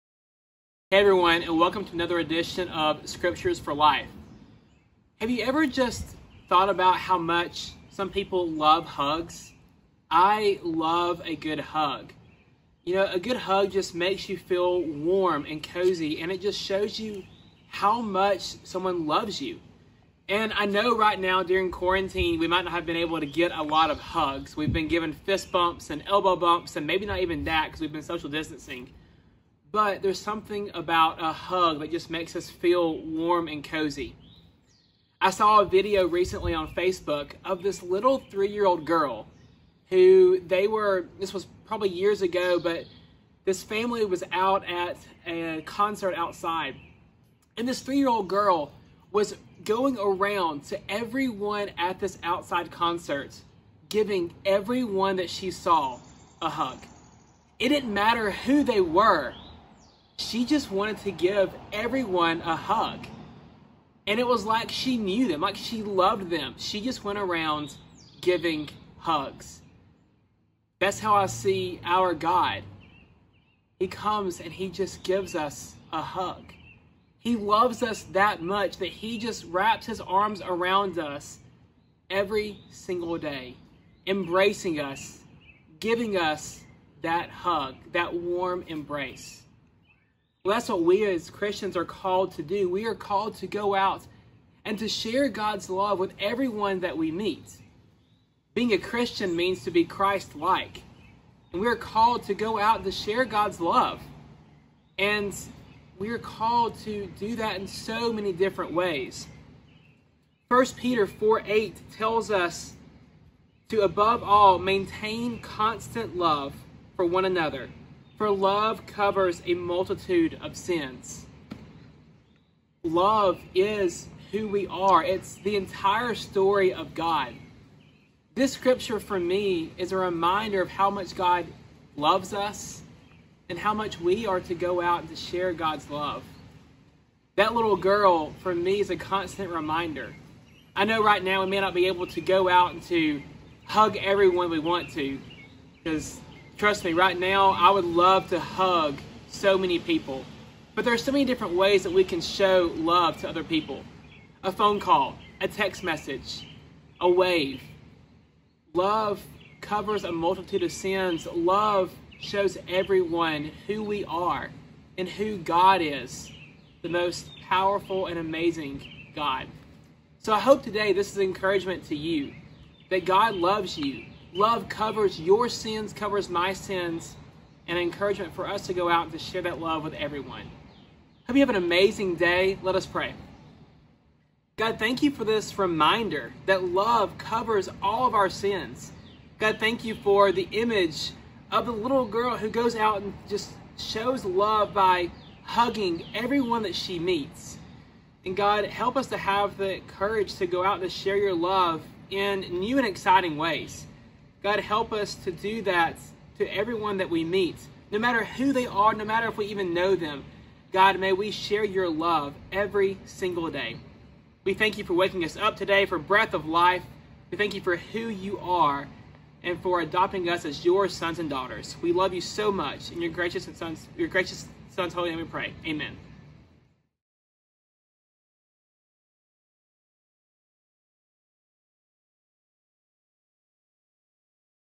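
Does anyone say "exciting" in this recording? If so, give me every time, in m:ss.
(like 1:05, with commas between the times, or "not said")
3:22.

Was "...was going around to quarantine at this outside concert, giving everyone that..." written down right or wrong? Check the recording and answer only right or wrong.
wrong.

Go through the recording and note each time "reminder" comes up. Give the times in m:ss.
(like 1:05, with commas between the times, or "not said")
2:09, 2:19, 3:05.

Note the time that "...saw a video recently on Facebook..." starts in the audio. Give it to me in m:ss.
0:35.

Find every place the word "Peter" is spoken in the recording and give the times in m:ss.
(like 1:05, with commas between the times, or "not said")
1:50.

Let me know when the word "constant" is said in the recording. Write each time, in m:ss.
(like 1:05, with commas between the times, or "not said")
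1:55, 2:18.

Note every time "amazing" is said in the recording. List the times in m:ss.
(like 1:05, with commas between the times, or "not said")
2:48, 3:01.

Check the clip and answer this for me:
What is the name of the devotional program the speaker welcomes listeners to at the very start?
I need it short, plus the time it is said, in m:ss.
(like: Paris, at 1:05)
Scriptures for Life, at 0:03.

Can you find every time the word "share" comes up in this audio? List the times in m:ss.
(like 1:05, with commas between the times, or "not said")
1:34, 1:42, 2:15, 2:59, 3:20, 3:31.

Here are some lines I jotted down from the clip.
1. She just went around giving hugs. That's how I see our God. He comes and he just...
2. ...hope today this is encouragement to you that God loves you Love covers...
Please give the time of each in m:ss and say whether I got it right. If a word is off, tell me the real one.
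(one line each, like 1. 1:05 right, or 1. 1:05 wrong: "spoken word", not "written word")
1. 1:06 right
2. 2:50 right.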